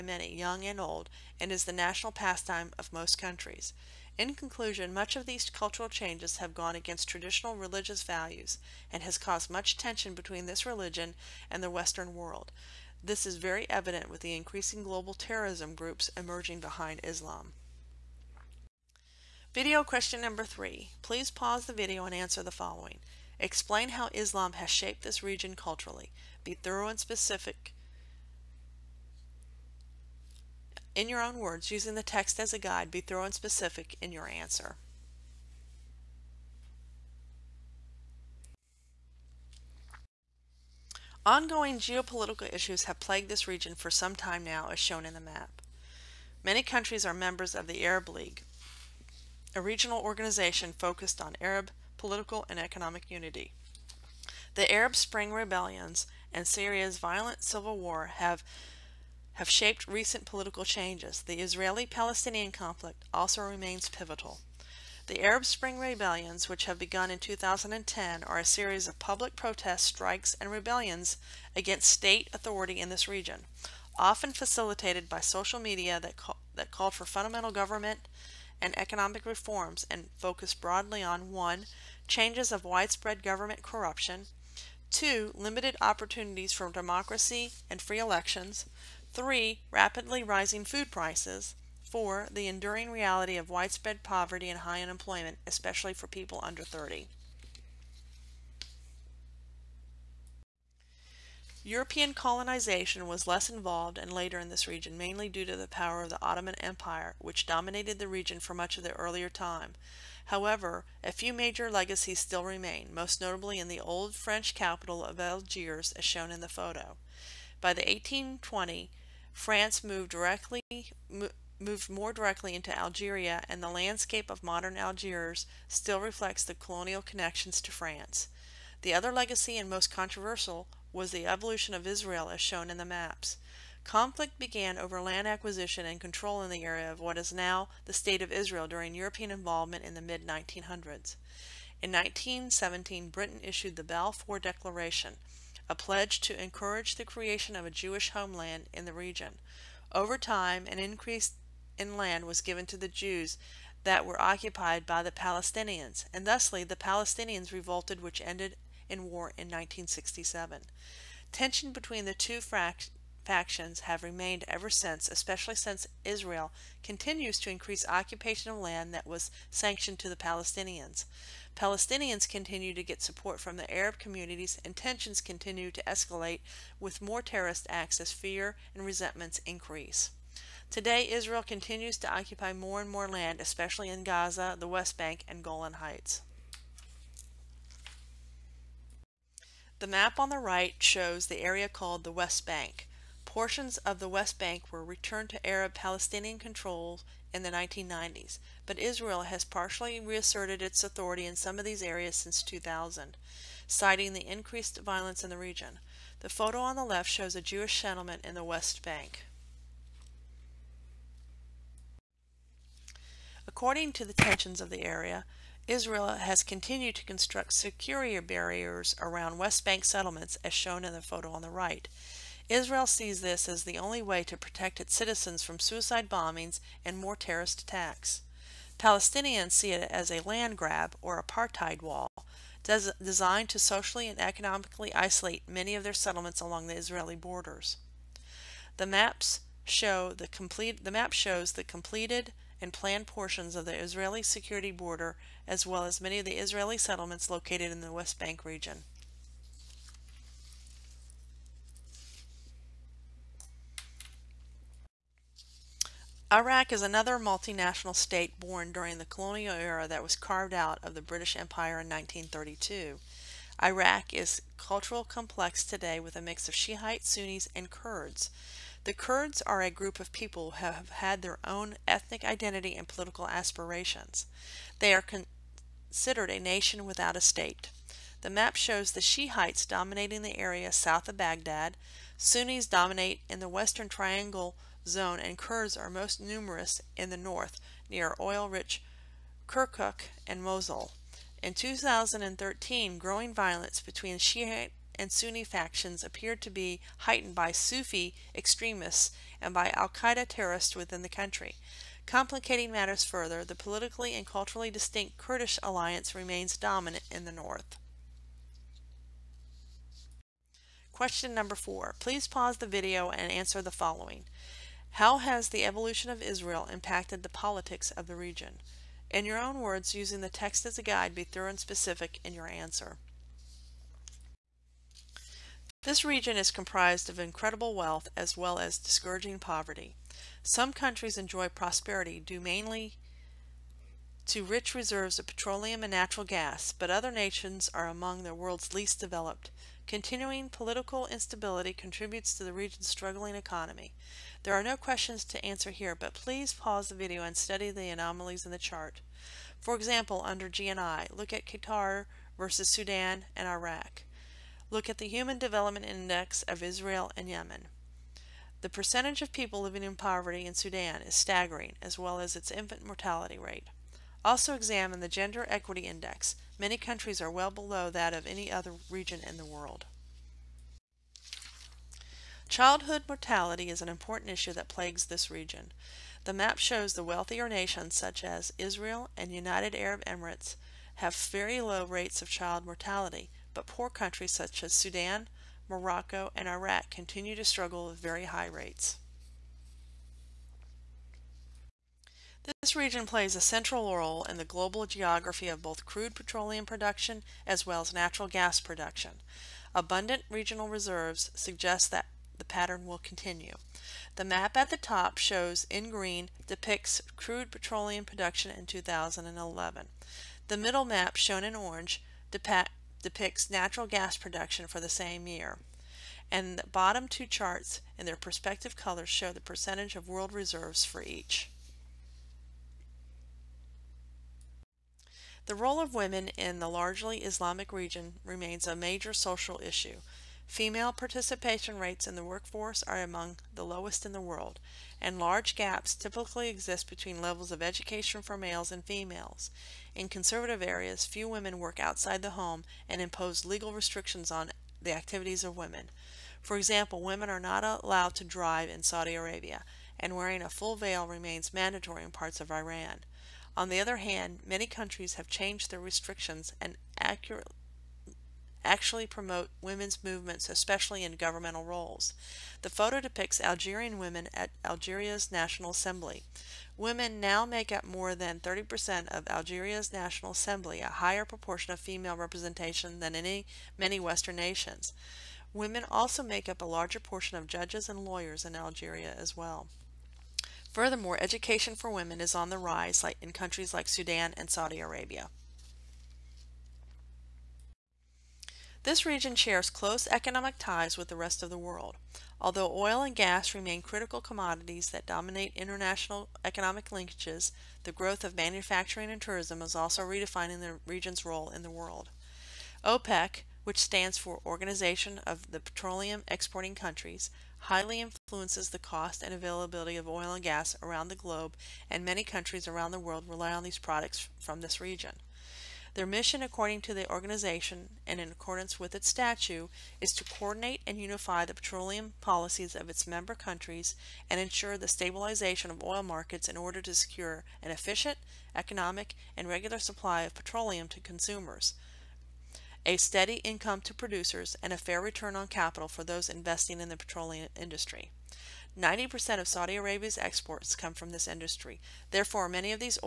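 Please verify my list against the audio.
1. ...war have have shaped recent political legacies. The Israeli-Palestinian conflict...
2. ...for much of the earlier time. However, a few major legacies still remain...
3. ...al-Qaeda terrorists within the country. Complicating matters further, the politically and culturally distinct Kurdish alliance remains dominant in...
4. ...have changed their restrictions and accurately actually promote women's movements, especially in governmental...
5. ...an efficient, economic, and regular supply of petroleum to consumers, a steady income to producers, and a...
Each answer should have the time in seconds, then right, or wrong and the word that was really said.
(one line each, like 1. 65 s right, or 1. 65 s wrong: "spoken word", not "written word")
1. 57 s wrong: "changes", not "legacies"
2. 108 s right
3. 299 s right
4. 455 s right
5. 527 s right.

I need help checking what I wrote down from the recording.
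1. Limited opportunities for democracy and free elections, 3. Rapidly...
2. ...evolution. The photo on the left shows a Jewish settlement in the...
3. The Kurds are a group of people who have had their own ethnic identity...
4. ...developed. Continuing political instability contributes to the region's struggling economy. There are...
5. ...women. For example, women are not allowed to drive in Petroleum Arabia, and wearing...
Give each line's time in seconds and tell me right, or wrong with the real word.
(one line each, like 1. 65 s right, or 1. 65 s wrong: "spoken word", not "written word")
1. 85 s right
2. 205 s wrong: "region", not "evolution"
3. 268 s right
4. 338 s right
5. 445 s wrong: "Saudi", not "Petroleum".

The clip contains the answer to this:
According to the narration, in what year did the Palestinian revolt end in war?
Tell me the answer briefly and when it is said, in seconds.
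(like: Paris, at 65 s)
1967, at 159 s.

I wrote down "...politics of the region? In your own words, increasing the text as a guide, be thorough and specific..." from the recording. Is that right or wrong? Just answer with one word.
wrong.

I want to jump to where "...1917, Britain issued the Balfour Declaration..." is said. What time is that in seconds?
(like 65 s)
141 s.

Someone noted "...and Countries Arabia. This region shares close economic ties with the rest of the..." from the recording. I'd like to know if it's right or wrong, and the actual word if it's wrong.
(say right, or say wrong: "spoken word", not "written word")
wrong: "Saudi", not "Countries".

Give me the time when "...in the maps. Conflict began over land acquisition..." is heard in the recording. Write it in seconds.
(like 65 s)
132 s.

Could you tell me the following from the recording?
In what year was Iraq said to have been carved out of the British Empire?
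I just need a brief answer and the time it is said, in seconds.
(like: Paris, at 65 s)
1932, at 261 s.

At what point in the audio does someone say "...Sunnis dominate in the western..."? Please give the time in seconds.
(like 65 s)
282 s.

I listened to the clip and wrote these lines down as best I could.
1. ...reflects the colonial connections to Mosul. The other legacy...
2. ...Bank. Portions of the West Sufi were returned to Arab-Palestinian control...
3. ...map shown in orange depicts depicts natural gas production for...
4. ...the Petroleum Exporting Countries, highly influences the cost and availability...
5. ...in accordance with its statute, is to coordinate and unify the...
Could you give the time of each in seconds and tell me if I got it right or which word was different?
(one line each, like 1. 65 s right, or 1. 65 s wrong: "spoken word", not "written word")
1. 125 s wrong: "France", not "Mosul"
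2. 192 s wrong: "Bank", not "Sufi"
3. 410 s right
4. 505 s right
5. 518 s right.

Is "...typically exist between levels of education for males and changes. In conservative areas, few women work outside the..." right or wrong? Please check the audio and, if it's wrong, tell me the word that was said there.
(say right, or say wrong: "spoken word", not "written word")
wrong: "females", not "changes".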